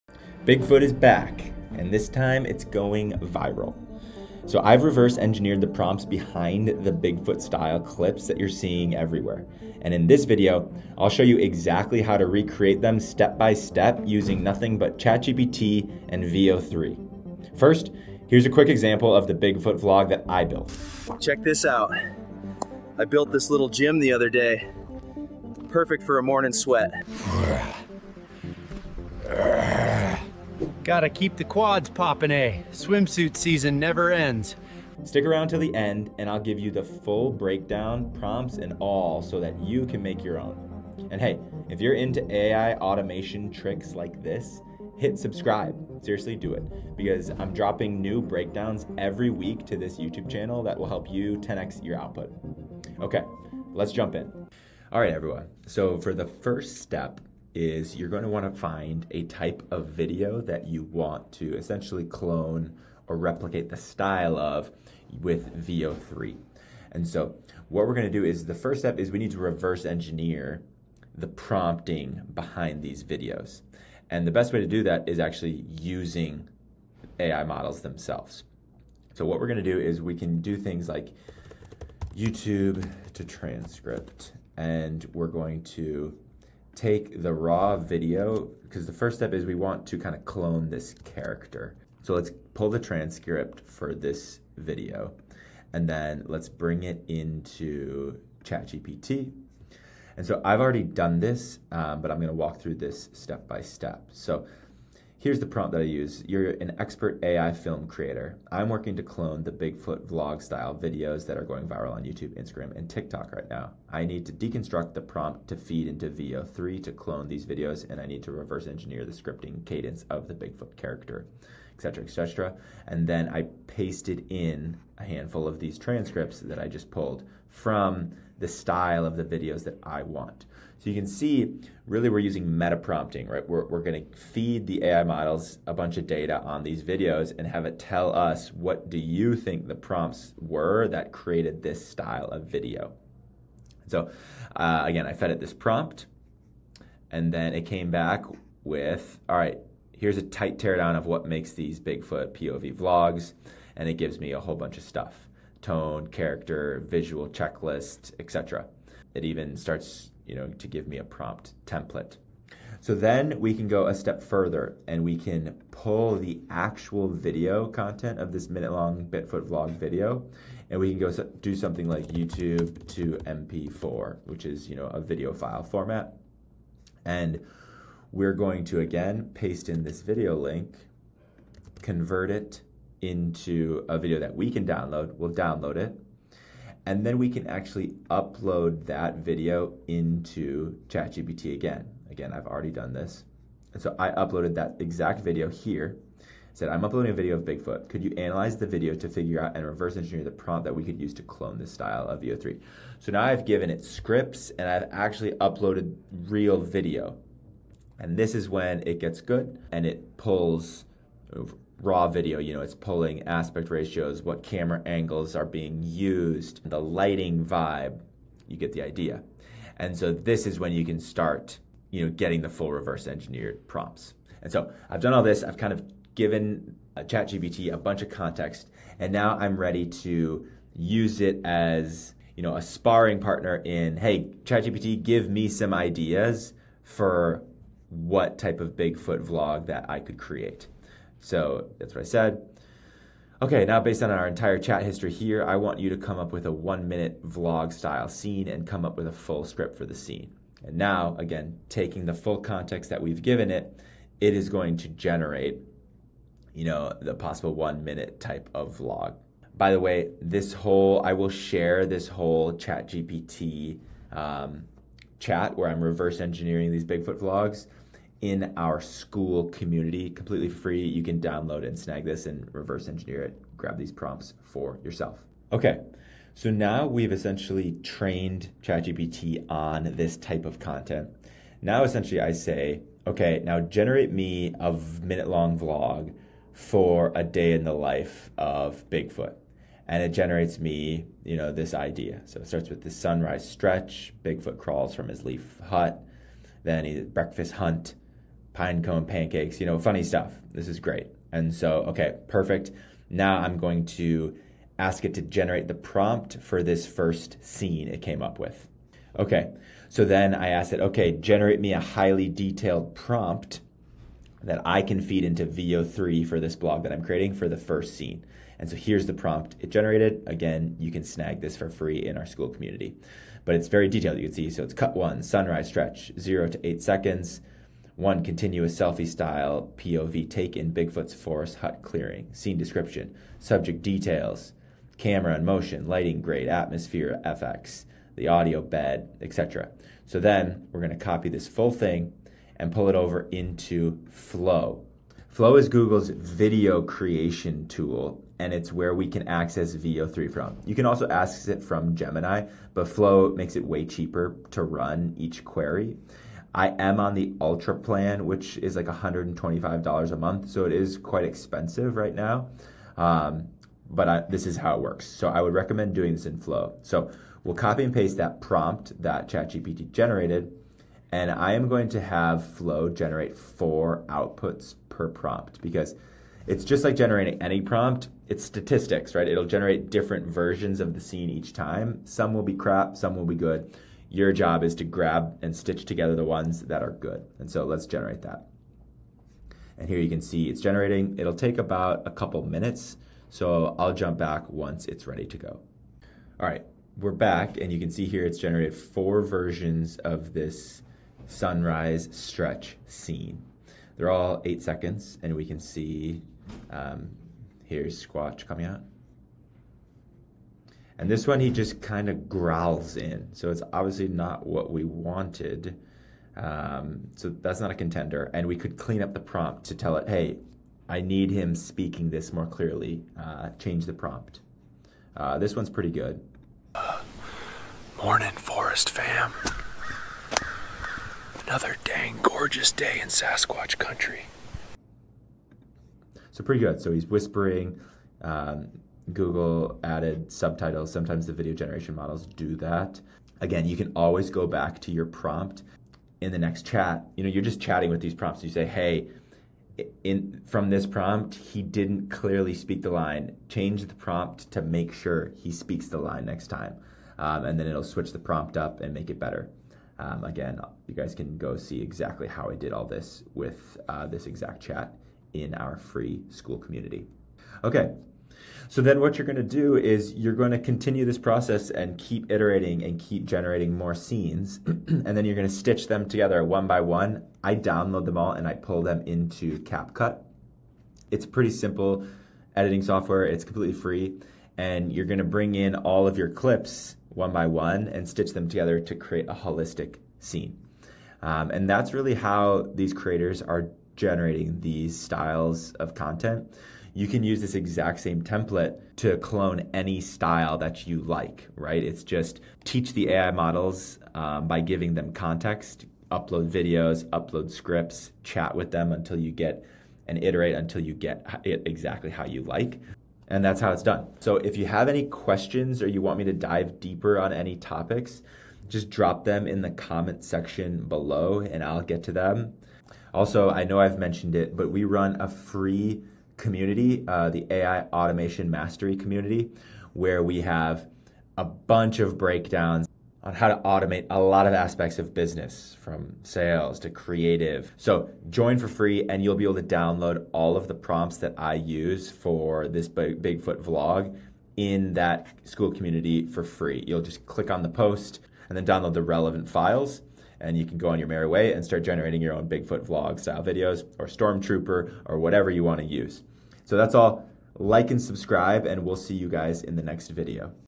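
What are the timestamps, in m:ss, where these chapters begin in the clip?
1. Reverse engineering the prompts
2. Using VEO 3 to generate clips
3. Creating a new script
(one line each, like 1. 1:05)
1. 0:55
2. 5:44
3. 2:23.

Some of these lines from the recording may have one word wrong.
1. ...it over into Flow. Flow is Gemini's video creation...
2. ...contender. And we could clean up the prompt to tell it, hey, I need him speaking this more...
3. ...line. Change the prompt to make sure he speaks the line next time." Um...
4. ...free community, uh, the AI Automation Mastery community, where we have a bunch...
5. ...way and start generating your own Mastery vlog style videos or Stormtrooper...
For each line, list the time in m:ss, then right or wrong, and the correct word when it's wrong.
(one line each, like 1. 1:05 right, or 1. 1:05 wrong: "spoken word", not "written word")
1. 5:42 wrong: "Google", not "Gemini"
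2. 6:57 right
3. 7:32 right
4. 8:45 right
5. 9:11 wrong: "Bigfoot", not "Mastery".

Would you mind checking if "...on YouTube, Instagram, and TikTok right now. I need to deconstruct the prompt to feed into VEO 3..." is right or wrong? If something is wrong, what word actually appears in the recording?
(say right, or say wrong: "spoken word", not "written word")
right.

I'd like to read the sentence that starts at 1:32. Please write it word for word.
So let's pull the transcript for this video and then let's bring it into ChatGPT.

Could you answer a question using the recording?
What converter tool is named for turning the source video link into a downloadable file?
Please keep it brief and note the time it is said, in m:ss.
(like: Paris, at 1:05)
YouTube to MP4, at 2:52.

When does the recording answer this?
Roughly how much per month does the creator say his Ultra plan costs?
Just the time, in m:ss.
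5:58.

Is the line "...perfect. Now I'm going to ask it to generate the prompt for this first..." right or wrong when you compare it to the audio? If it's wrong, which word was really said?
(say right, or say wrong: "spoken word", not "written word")
right.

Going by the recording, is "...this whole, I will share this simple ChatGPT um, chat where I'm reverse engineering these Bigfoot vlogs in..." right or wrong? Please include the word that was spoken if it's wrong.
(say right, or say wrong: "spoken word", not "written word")
wrong: "whole", not "simple".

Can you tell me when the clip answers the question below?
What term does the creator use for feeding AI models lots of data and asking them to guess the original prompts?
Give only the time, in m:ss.
2:12.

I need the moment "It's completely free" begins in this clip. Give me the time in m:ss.
8:03.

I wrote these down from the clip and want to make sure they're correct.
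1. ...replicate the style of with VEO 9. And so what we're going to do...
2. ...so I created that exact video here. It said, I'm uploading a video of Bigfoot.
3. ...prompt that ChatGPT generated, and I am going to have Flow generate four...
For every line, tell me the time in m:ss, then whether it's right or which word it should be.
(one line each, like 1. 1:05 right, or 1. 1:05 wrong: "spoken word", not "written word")
1. 1:03 wrong: "3", not "9"
2. 3:13 wrong: "uploaded", not "created"
3. 6:08 right.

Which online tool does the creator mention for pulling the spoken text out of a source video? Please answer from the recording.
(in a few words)
YouTube to transcript.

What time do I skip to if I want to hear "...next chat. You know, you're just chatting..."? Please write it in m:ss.
7:26.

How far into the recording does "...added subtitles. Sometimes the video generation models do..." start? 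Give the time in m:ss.
7:19.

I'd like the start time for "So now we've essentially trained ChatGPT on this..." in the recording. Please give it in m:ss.
4:36.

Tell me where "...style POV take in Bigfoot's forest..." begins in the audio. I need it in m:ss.
5:29.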